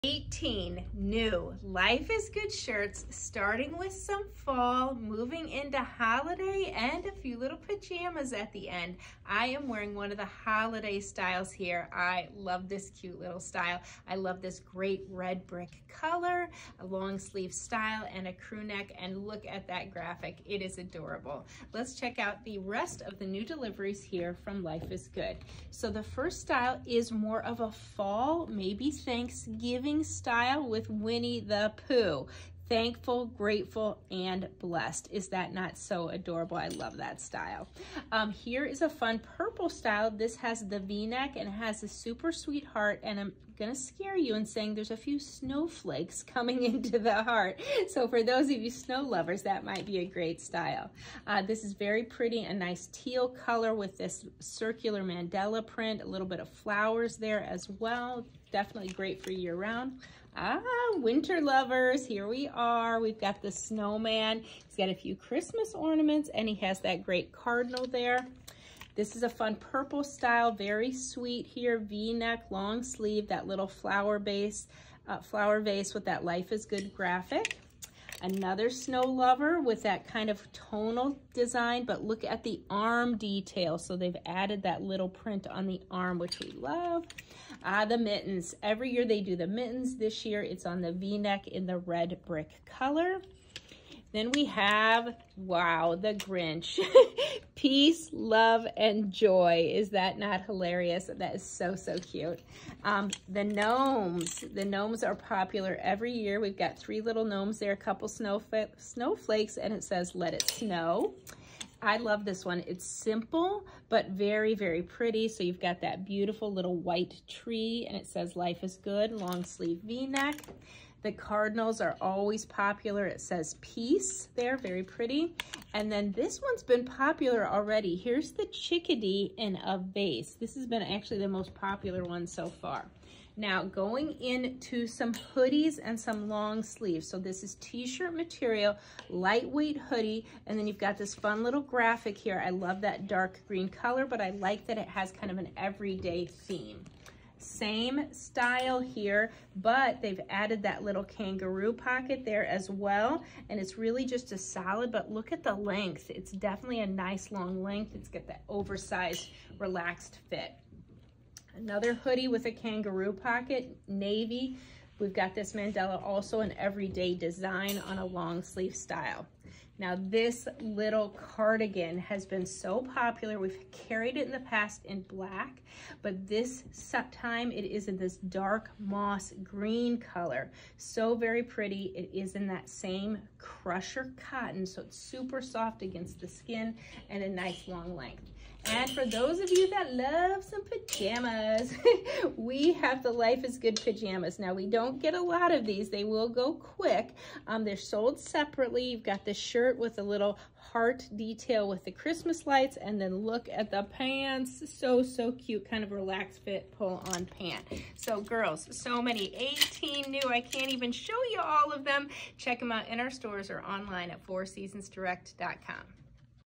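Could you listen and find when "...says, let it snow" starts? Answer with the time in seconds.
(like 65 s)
109 s.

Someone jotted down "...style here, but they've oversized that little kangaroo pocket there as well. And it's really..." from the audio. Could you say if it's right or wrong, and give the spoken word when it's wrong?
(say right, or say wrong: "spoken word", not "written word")
wrong: "added", not "oversized".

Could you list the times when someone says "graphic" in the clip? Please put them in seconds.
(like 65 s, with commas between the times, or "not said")
19 s, 76 s, 141 s.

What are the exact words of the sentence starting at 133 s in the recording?
Now going into some hoodies and some long sleeves.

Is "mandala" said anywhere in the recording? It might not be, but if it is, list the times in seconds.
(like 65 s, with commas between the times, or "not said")
55 s, 165 s.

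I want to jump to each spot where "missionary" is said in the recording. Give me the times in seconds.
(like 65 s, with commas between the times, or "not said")
not said.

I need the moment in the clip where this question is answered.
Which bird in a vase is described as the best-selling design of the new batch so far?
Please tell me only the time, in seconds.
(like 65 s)
128 s.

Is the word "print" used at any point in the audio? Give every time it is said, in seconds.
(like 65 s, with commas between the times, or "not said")
55 s, 85 s.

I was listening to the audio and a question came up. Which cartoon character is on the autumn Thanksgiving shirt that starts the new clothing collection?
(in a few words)
Winnie the Pooh.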